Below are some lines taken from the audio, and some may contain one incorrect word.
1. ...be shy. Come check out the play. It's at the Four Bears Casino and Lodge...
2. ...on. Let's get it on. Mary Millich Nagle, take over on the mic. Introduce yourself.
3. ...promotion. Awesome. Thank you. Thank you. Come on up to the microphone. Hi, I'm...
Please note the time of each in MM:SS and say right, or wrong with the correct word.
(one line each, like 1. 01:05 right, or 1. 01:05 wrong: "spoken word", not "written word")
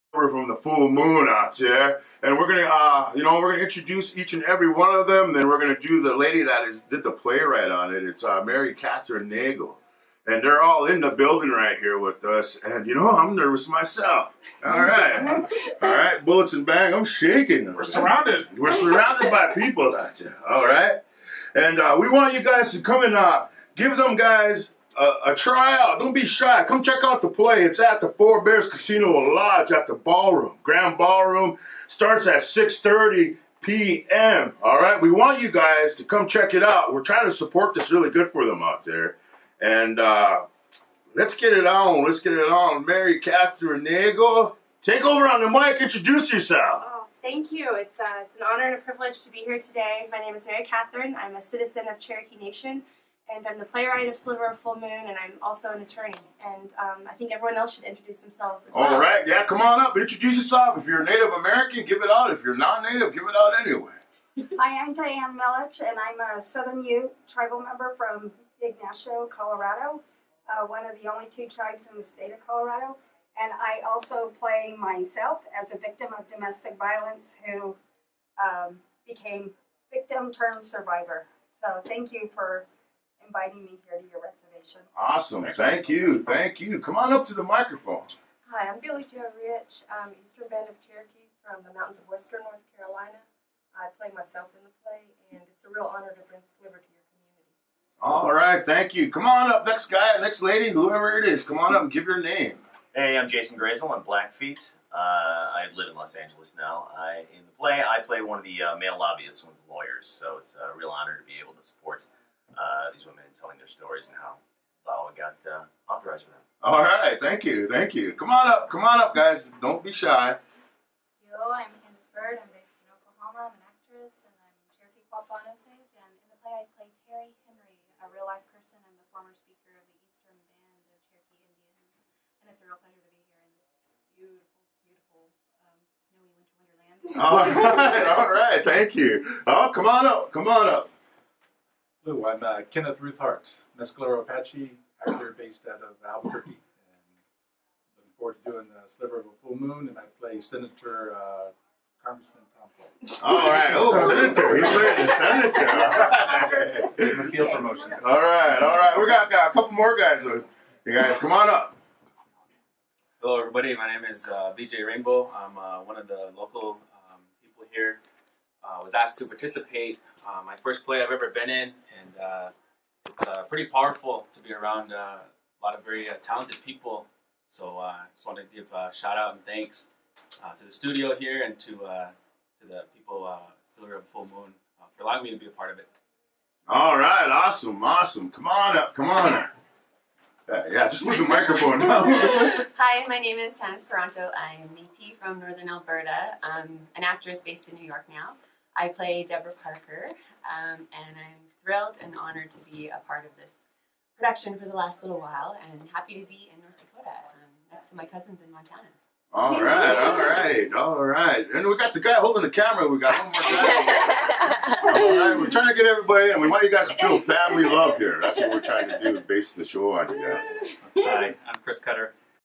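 1. 00:26 right
2. 00:41 wrong: "Kathryn", not "Millich"
3. 01:24 wrong: "reservation", not "promotion".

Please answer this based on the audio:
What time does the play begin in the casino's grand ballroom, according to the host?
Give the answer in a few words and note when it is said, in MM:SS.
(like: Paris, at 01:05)
6:30 p.m., at 00:32.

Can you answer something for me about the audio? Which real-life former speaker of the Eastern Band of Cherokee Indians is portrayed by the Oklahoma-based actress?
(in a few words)
Terri Henry.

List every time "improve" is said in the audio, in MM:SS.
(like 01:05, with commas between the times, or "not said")
not said.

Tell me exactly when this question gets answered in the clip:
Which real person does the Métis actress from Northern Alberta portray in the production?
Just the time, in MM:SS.
03:19.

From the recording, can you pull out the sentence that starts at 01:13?
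And I also play myself as a victim of domestic violence who um, became victim turned survivor.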